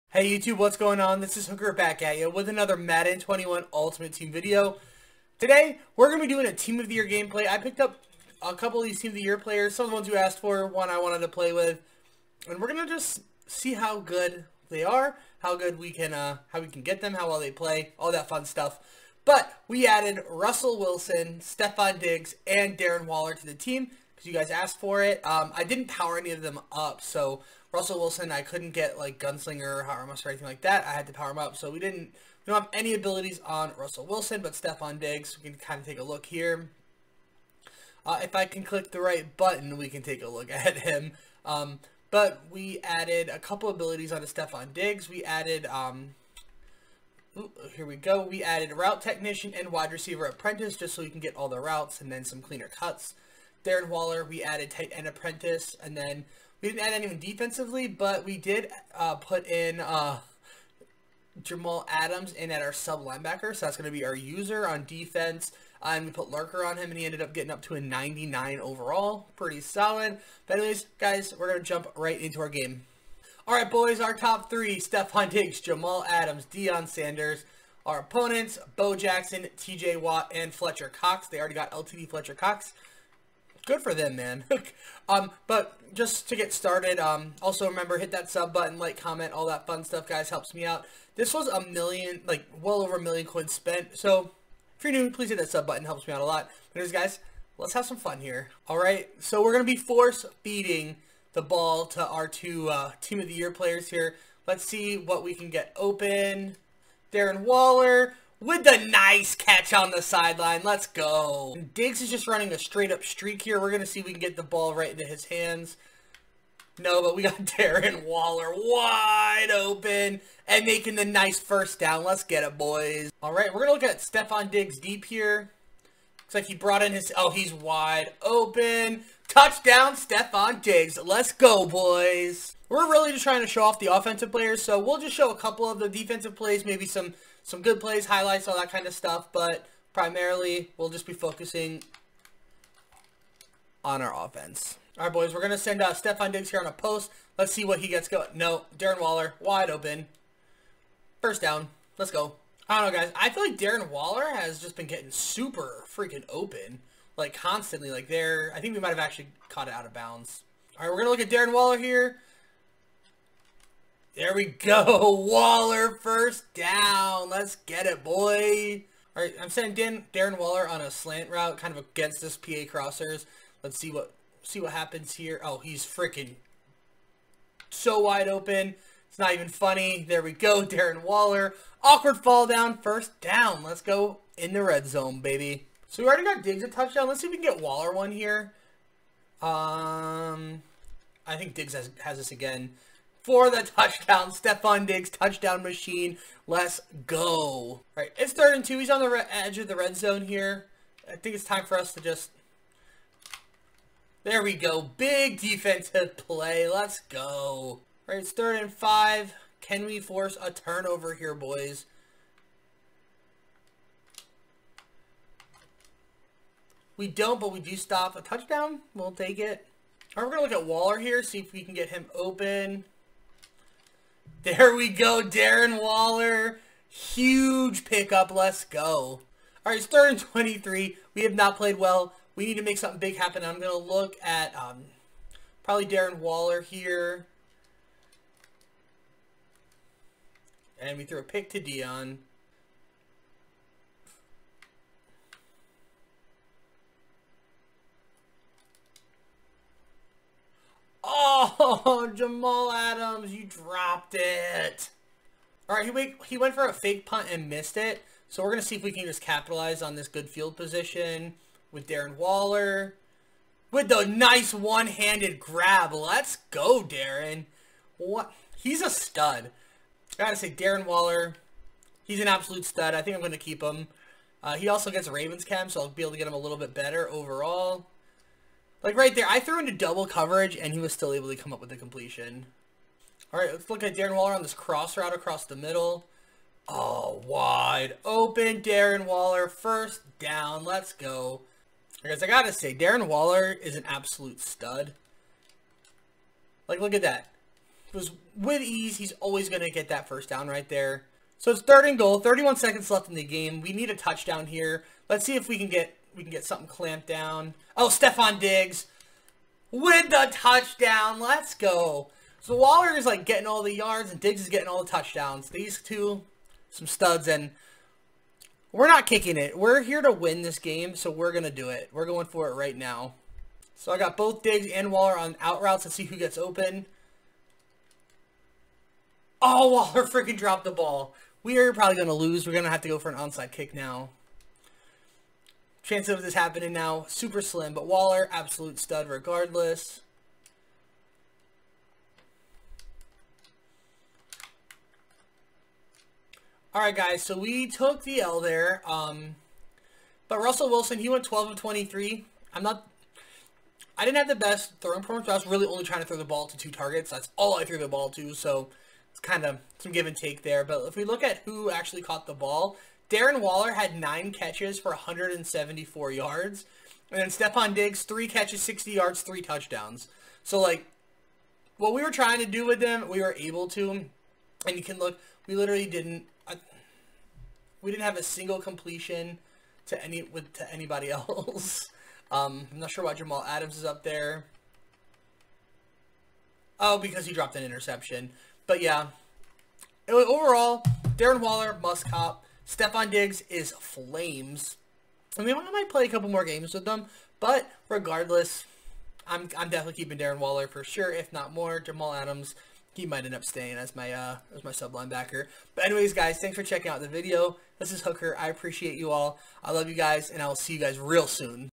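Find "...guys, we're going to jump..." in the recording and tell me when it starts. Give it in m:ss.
1:10.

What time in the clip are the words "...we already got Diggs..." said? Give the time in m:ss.
3:06.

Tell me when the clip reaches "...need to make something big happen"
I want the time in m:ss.
3:52.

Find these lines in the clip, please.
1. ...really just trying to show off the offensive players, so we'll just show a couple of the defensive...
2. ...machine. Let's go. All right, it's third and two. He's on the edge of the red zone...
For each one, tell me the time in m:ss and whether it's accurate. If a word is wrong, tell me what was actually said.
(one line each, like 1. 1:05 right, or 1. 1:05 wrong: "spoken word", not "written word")
1. 2:12 right
2. 3:15 right.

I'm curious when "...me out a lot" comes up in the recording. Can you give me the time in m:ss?
1:36.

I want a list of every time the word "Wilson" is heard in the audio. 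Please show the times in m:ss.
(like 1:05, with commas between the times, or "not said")
0:20, 0:27, 0:34, 5:50.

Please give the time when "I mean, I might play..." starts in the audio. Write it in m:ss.
6:35.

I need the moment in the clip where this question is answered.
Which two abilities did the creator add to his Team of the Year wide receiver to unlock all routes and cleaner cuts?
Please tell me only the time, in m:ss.
0:48.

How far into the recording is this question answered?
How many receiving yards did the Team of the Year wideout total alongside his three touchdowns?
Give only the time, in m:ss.
6:08.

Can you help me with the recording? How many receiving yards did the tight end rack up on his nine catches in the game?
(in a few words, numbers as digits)
174.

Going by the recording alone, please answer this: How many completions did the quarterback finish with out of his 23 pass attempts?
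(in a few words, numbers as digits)
12.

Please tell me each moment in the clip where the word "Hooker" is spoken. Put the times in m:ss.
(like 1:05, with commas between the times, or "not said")
0:01, 6:48.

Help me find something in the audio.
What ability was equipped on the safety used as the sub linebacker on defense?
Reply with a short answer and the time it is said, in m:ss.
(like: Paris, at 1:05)
Lurker, at 1:06.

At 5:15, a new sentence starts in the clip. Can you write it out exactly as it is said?
These two, some studs, and we're not kicking it.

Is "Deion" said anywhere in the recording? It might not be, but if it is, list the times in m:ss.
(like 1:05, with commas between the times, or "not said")
1:16, 4:01.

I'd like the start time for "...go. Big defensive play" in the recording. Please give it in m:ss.
3:24.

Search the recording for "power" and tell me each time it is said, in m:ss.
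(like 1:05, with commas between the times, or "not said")
0:25, 0:31.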